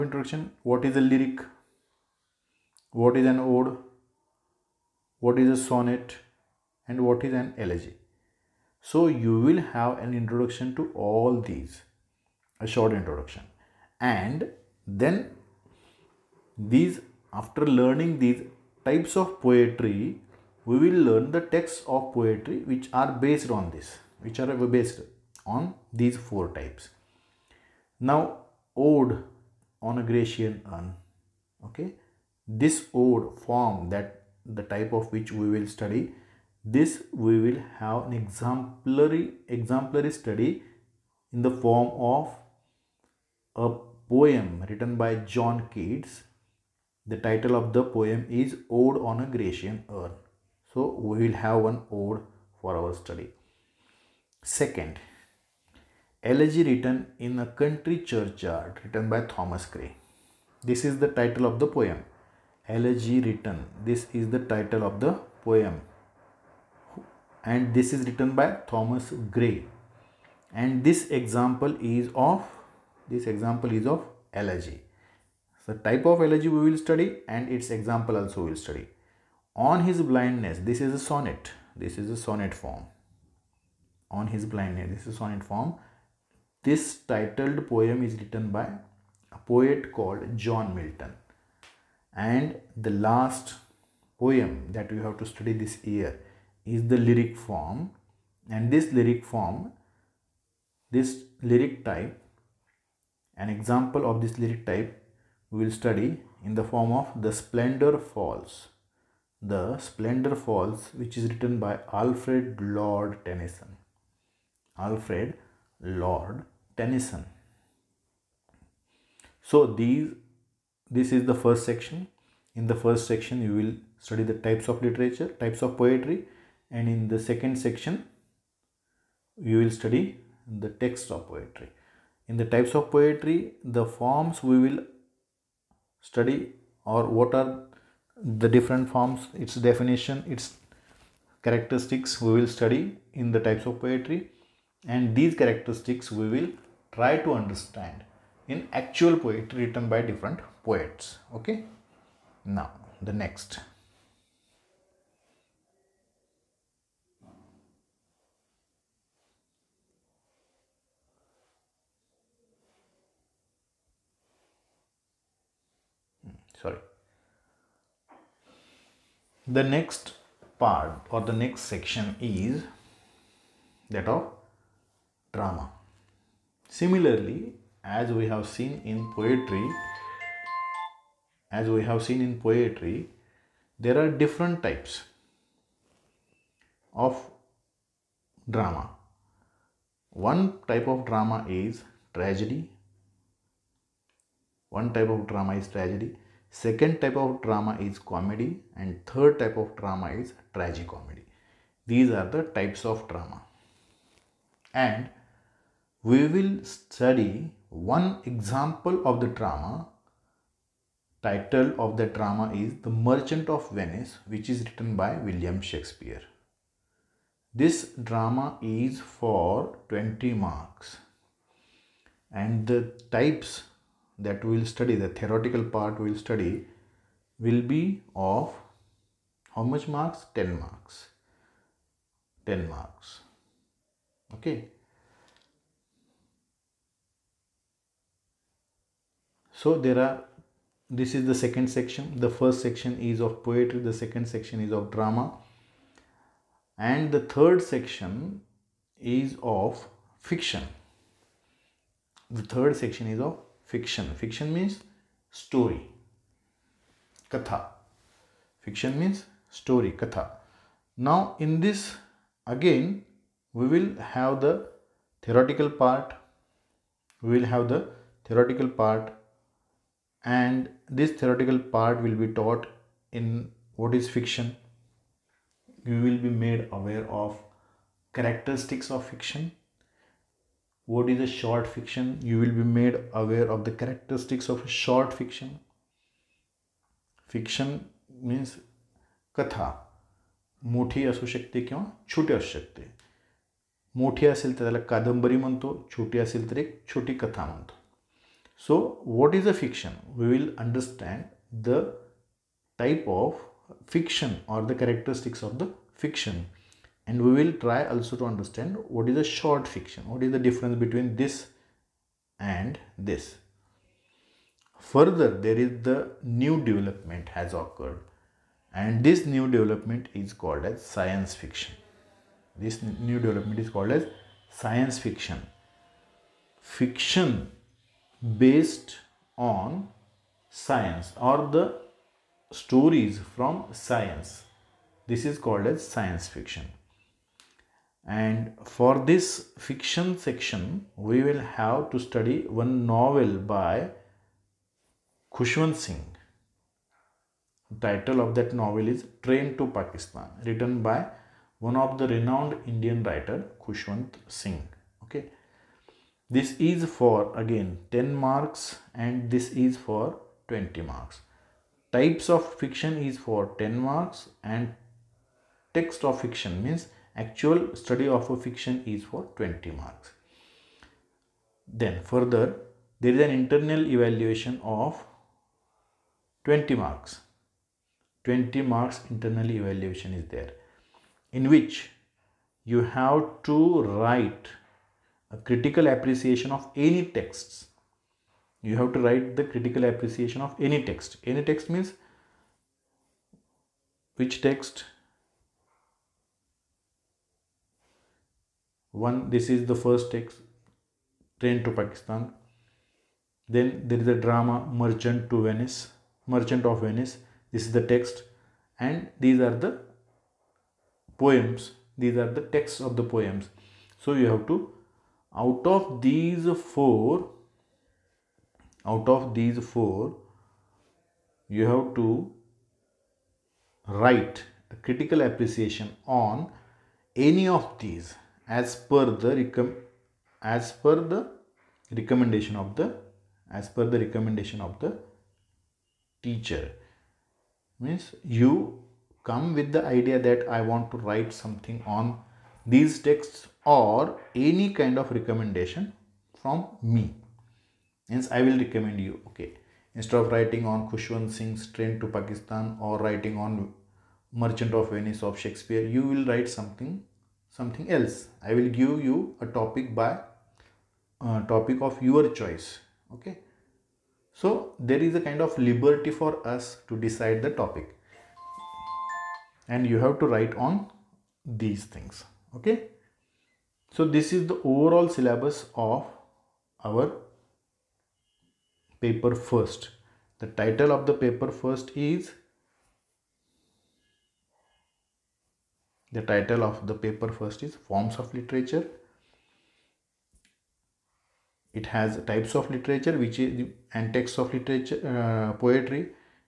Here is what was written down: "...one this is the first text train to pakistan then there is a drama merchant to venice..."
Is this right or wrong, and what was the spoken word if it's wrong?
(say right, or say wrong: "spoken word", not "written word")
right.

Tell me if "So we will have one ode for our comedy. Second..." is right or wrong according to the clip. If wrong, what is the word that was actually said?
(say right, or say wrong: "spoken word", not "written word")
wrong: "study", not "comedy".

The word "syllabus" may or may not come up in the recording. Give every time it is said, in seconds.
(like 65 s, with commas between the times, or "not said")
475 s.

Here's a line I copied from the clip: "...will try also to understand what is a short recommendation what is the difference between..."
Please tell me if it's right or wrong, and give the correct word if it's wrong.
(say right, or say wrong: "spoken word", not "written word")
wrong: "fiction", not "recommendation".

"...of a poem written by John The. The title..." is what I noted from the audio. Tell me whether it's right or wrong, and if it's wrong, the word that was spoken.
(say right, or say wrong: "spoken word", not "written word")
wrong: "Keats", not "The".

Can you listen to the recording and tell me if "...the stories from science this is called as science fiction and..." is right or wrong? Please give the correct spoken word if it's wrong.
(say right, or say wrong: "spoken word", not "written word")
right.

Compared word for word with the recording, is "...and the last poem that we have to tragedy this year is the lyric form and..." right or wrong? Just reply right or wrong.
wrong.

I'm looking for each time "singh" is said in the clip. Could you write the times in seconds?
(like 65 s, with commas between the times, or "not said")
345 s, 354 s, 451 s.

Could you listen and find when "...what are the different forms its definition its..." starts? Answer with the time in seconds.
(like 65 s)
137 s.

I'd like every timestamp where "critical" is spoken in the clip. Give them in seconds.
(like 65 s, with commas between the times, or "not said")
385 s, 389 s, 424 s.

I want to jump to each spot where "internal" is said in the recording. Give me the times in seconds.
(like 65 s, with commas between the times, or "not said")
373 s, 379 s.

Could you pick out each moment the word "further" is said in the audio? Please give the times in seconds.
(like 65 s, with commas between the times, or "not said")
314 s, 372 s.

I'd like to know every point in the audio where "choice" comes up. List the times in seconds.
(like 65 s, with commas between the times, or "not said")
462 s.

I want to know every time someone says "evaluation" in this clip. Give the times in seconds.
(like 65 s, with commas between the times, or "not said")
373 s, 379 s.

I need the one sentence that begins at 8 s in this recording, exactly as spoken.
So you will have an introduction to all these, a short introduction.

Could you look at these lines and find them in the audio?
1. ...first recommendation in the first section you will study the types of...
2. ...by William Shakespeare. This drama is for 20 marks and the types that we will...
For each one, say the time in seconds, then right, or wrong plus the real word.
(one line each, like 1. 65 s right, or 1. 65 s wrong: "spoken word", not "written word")
1. 121 s wrong: "section", not "recommendation"
2. 214 s right.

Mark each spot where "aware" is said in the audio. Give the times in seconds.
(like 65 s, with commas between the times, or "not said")
276 s, 283 s.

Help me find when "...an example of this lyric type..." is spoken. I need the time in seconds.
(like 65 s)
103 s.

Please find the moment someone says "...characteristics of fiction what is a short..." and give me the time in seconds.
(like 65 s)
278 s.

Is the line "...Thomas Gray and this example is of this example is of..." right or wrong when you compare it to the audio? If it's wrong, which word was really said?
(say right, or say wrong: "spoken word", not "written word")
right.